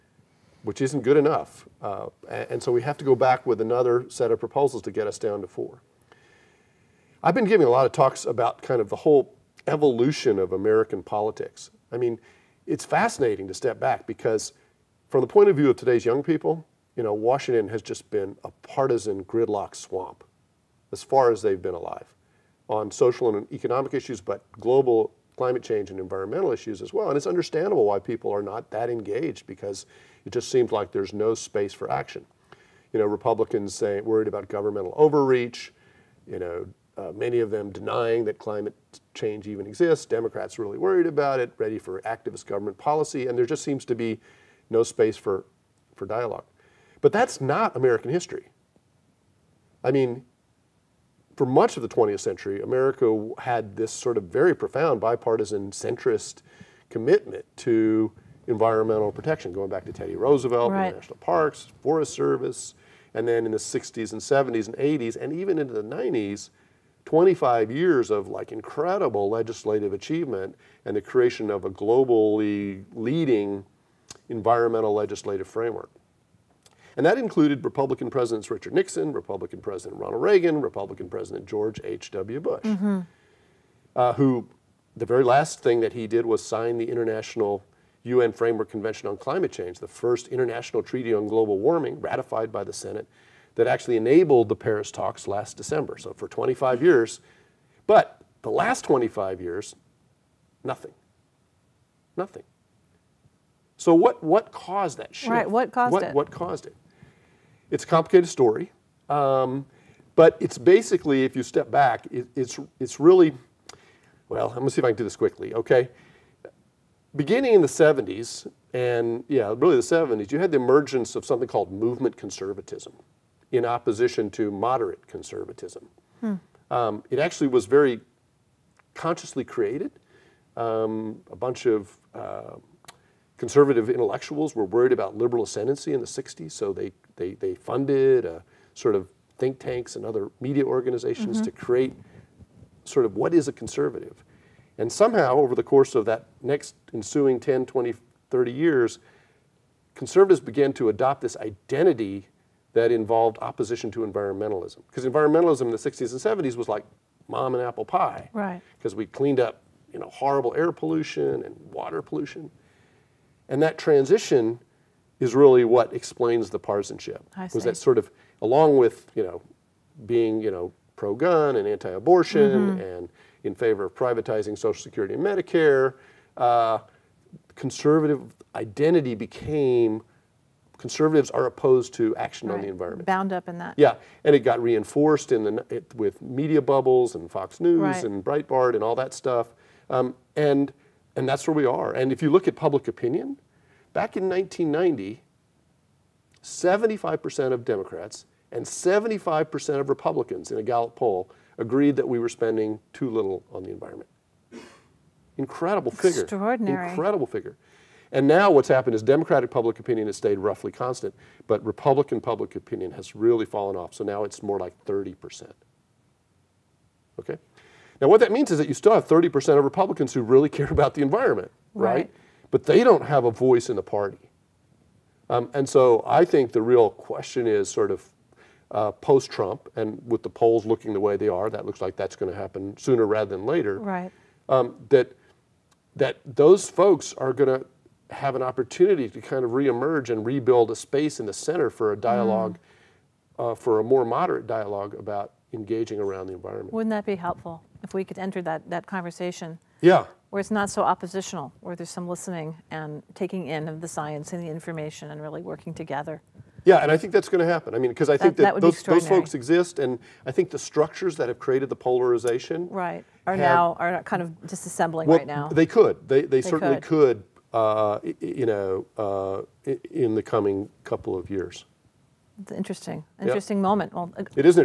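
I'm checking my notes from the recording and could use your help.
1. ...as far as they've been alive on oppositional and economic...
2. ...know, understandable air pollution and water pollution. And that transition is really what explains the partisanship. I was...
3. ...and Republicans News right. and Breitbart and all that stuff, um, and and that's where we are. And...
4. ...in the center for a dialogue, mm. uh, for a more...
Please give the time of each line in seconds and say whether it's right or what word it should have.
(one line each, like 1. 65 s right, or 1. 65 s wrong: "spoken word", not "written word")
1. 20 s wrong: "social", not "oppositional"
2. 159 s wrong: "horrible", not "understandable"
3. 187 s wrong: "Fox", not "Republicans"
4. 241 s right.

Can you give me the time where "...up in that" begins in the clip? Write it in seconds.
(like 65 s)
183 s.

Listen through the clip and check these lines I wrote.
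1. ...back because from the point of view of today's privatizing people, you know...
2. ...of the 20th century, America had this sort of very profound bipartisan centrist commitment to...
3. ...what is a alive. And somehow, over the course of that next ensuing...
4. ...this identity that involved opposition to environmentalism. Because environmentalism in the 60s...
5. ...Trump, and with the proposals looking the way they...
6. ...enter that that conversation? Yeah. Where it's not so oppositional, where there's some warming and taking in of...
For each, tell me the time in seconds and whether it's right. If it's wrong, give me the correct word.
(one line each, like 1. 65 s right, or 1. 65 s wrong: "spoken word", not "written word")
1. 13 s wrong: "young", not "privatizing"
2. 51 s right
3. 143 s wrong: "conservative", not "alive"
4. 151 s right
5. 229 s wrong: "polls", not "proposals"
6. 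248 s wrong: "listening", not "warming".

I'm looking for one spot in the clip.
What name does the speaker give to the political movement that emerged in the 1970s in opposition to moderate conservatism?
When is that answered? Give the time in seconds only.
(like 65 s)
121 s.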